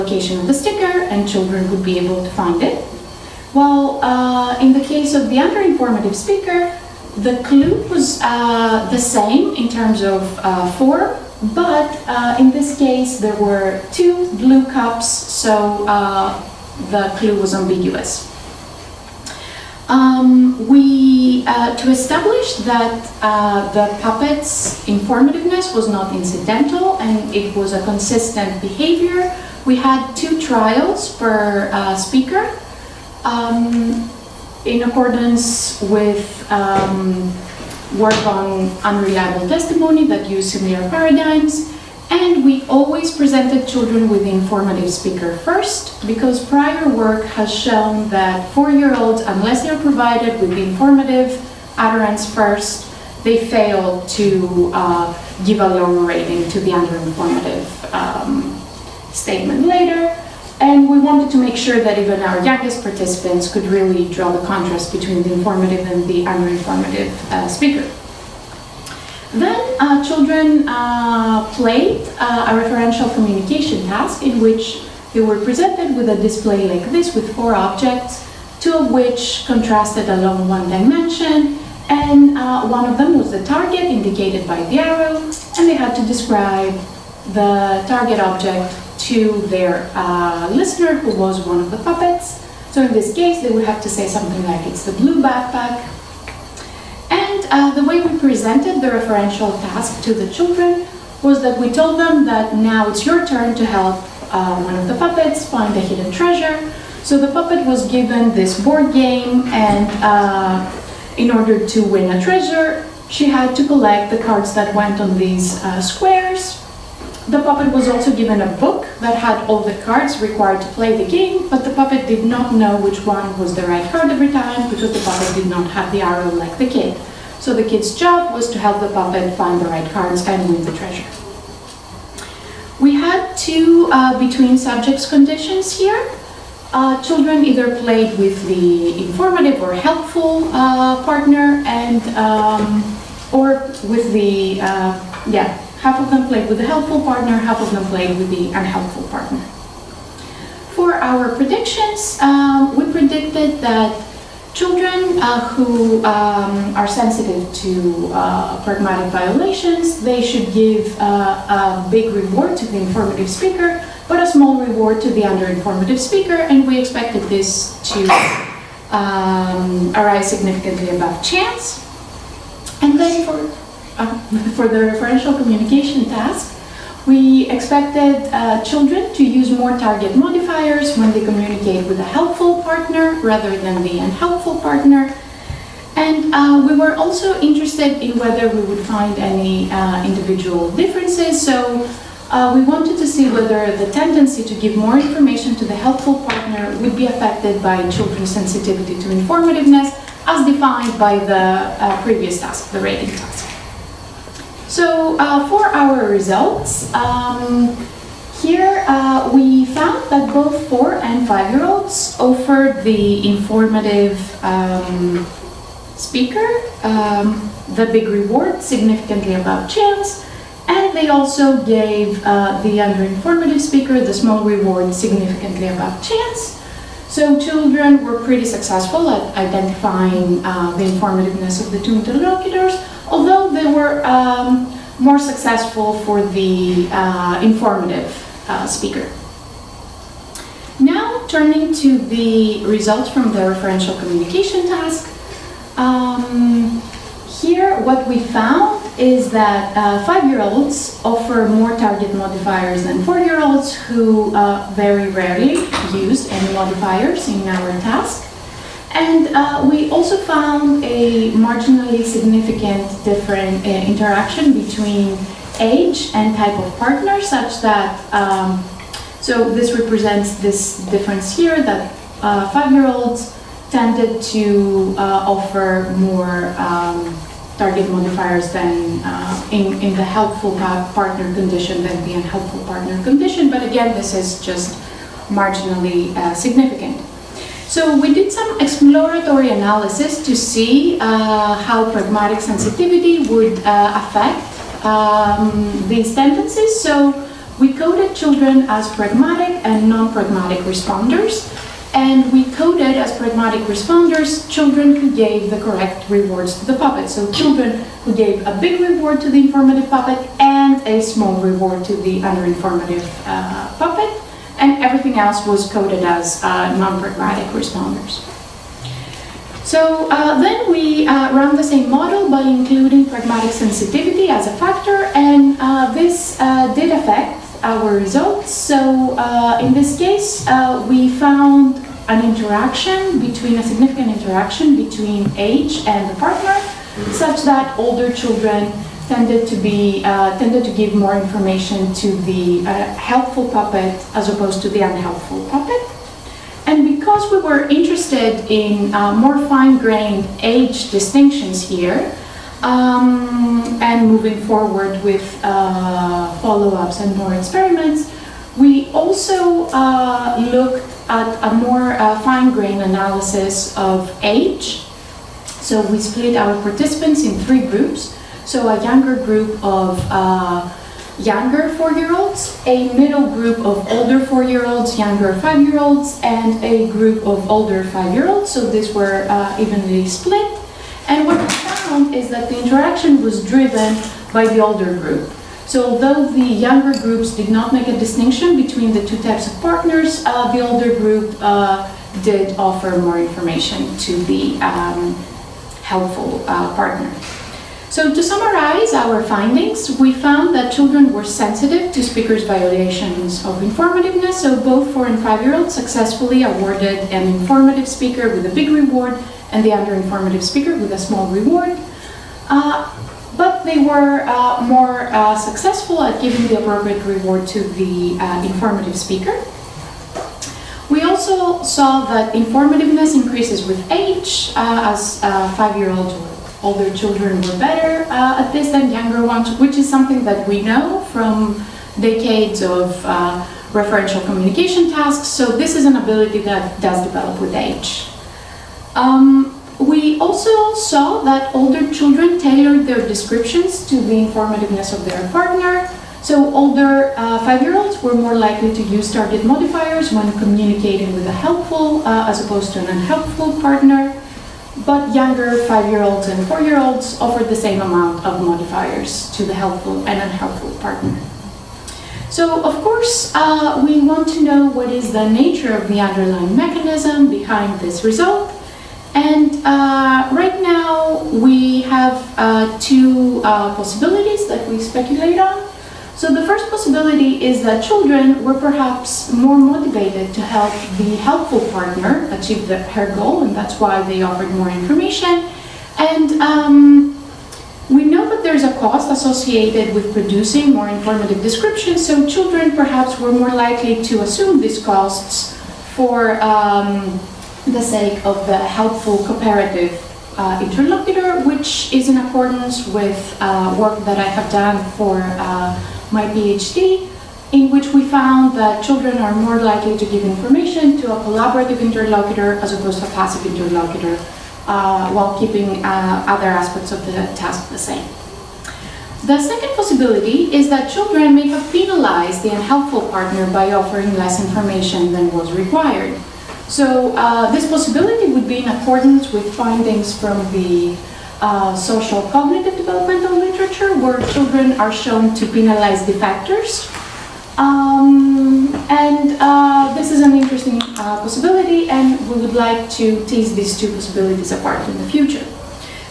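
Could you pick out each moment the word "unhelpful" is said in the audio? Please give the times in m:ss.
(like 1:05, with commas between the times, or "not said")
2:28, 3:03, 4:42, 5:44, 7:32, 7:40, 8:42.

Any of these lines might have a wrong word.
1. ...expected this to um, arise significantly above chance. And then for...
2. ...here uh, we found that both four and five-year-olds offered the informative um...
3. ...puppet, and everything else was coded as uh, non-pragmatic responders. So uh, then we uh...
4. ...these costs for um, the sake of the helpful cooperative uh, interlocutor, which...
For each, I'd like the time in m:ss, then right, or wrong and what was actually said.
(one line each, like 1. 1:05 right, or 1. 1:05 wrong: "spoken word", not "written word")
1. 2:46 right
2. 3:28 right
3. 5:13 right
4. 8:14 right.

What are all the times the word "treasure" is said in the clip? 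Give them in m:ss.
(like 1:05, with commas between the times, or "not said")
1:46, 1:52, 2:10.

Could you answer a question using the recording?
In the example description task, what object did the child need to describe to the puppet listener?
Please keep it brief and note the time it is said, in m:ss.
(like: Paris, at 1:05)
blue backpack, at 1:34.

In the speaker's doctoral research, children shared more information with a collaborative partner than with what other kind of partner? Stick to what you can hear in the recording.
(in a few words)
passive interlocutor.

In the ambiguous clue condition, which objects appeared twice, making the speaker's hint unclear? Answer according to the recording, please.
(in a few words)
two blue cups.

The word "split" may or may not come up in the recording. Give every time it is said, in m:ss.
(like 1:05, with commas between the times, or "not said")
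6:05, 6:20.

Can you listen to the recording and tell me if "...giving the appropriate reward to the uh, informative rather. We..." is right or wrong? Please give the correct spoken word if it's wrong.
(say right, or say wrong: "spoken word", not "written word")
wrong: "speaker", not "rather".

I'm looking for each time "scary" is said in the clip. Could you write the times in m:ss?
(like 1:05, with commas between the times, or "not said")
not said.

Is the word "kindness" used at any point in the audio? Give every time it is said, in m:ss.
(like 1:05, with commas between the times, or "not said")
not said.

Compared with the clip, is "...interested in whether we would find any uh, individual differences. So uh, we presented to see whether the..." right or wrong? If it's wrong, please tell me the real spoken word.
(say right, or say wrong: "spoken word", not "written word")
wrong: "wanted", not "presented".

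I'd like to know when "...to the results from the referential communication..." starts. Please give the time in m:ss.
4:01.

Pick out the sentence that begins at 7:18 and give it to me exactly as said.
Um, we also saw that older children tailored their descriptions to the informativeness of their partner.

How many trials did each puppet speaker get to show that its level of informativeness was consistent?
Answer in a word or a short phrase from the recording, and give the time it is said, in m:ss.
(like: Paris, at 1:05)
2, at 0:30.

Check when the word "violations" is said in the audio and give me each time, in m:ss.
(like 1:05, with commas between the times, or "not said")
2:39, 6:42.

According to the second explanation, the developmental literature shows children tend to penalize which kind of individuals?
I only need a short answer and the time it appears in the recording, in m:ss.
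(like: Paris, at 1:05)
defectors, at 8:56.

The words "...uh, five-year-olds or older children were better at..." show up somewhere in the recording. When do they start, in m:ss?
7:05.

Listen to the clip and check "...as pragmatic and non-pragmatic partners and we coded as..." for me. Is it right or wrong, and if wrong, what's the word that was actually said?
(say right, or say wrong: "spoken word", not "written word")
wrong: "responders", not "partners".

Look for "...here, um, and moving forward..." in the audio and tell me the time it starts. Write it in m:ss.
5:51.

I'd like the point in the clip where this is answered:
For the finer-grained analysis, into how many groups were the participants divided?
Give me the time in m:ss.
6:07.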